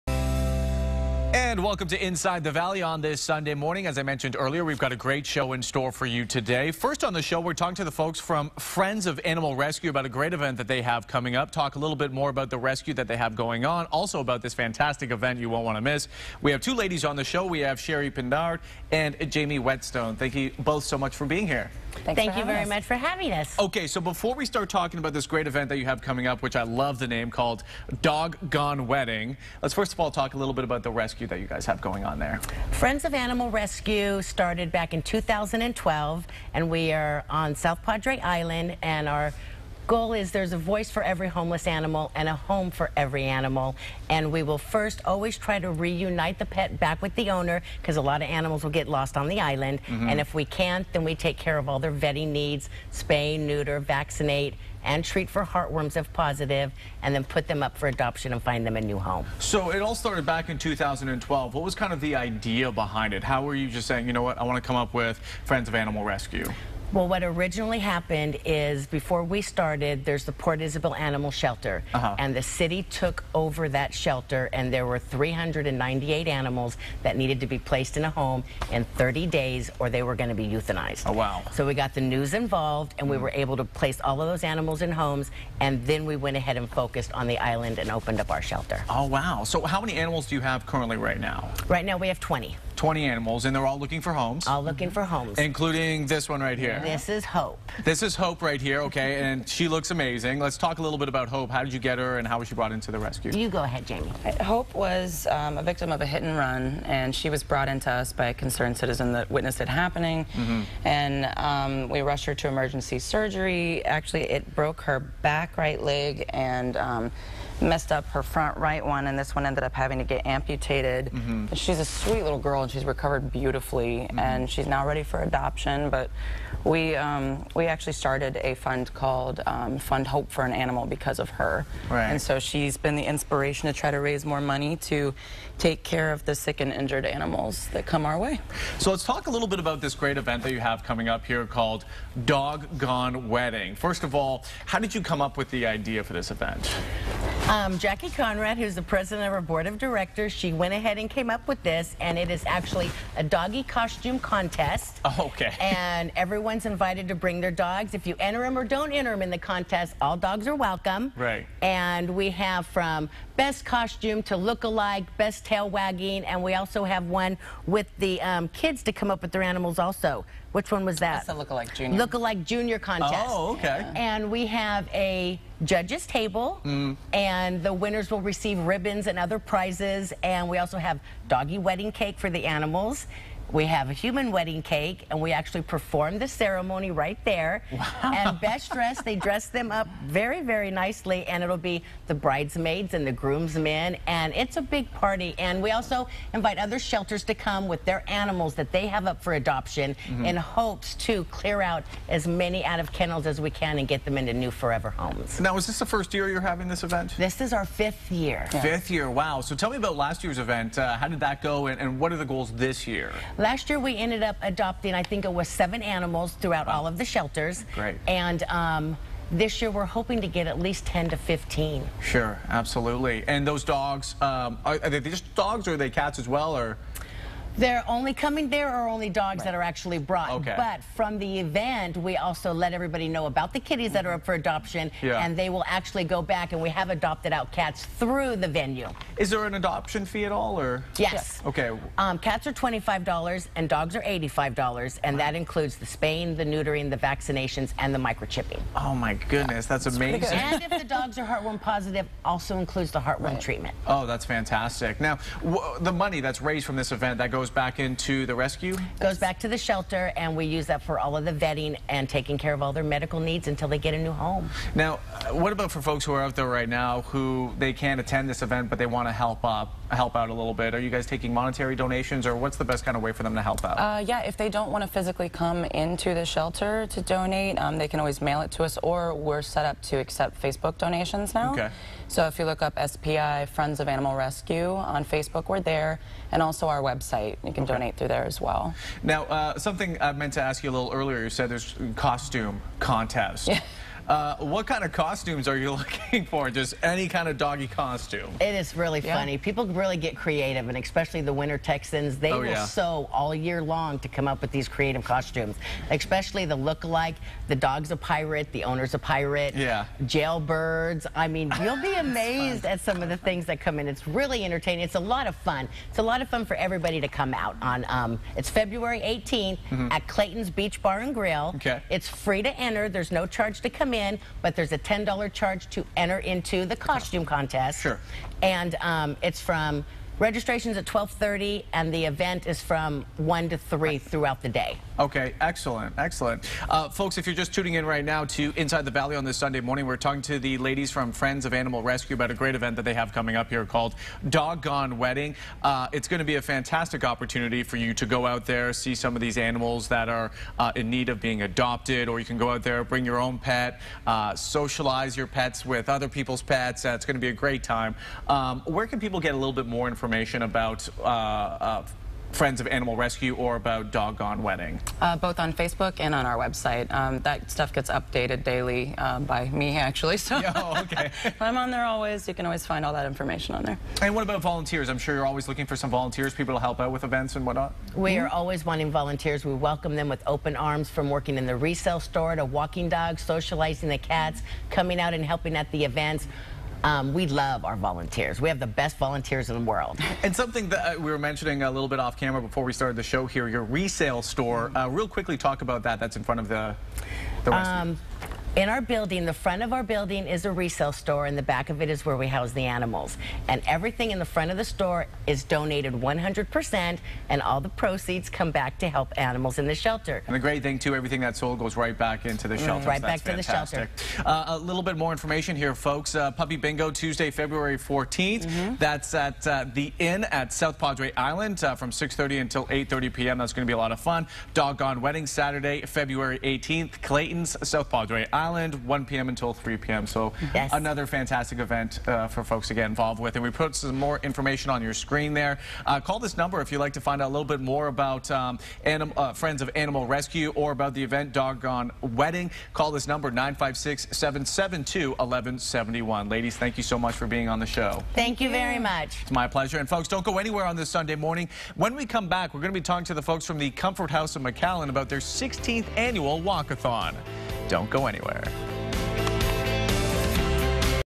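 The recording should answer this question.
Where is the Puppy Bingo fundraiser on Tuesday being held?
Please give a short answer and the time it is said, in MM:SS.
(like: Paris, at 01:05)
The Inn at South Padre Island, at 06:59.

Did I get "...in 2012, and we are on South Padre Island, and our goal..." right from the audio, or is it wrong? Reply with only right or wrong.
right.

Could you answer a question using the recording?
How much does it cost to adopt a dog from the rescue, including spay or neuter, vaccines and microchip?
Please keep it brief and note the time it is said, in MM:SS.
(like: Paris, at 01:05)
$85, at 04:04.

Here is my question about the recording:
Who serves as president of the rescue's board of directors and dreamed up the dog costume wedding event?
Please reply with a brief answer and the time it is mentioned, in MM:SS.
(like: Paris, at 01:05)
Jackie Conrad, at 02:27.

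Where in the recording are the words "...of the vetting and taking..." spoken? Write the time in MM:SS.
04:21.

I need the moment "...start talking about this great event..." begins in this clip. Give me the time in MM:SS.
00:24.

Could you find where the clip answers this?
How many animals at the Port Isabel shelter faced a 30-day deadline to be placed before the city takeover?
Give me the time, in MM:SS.
01:14.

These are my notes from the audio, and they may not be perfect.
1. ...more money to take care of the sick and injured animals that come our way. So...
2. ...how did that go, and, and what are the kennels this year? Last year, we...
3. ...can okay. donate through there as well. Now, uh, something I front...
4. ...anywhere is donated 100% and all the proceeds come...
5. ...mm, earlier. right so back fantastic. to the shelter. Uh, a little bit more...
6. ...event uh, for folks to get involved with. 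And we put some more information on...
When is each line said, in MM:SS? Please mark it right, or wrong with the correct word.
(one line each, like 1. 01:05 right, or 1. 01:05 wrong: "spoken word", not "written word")
1. 02:14 right
2. 03:31 wrong: "goals", not "kennels"
3. 04:47 wrong: "meant", not "front"
4. 06:44 wrong: "store", not "anywhere"
5. 06:52 wrong: "shelter", not "earlier"
6. 07:11 right.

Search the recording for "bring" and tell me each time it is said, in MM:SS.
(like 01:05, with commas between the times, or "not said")
02:37, 05:52.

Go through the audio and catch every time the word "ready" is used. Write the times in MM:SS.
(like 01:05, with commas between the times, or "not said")
02:04.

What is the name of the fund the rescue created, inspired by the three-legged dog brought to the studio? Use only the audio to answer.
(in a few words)
Fund Hope for an Animal.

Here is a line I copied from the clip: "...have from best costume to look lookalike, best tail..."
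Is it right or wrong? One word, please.
wrong.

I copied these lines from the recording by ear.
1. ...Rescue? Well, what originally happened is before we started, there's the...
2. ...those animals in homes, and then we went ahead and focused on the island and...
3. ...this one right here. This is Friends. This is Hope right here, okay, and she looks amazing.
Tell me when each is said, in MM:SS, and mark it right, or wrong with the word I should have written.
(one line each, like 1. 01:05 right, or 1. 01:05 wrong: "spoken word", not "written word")
1. 01:06 right
2. 01:24 right
3. 01:36 wrong: "Hope", not "Friends".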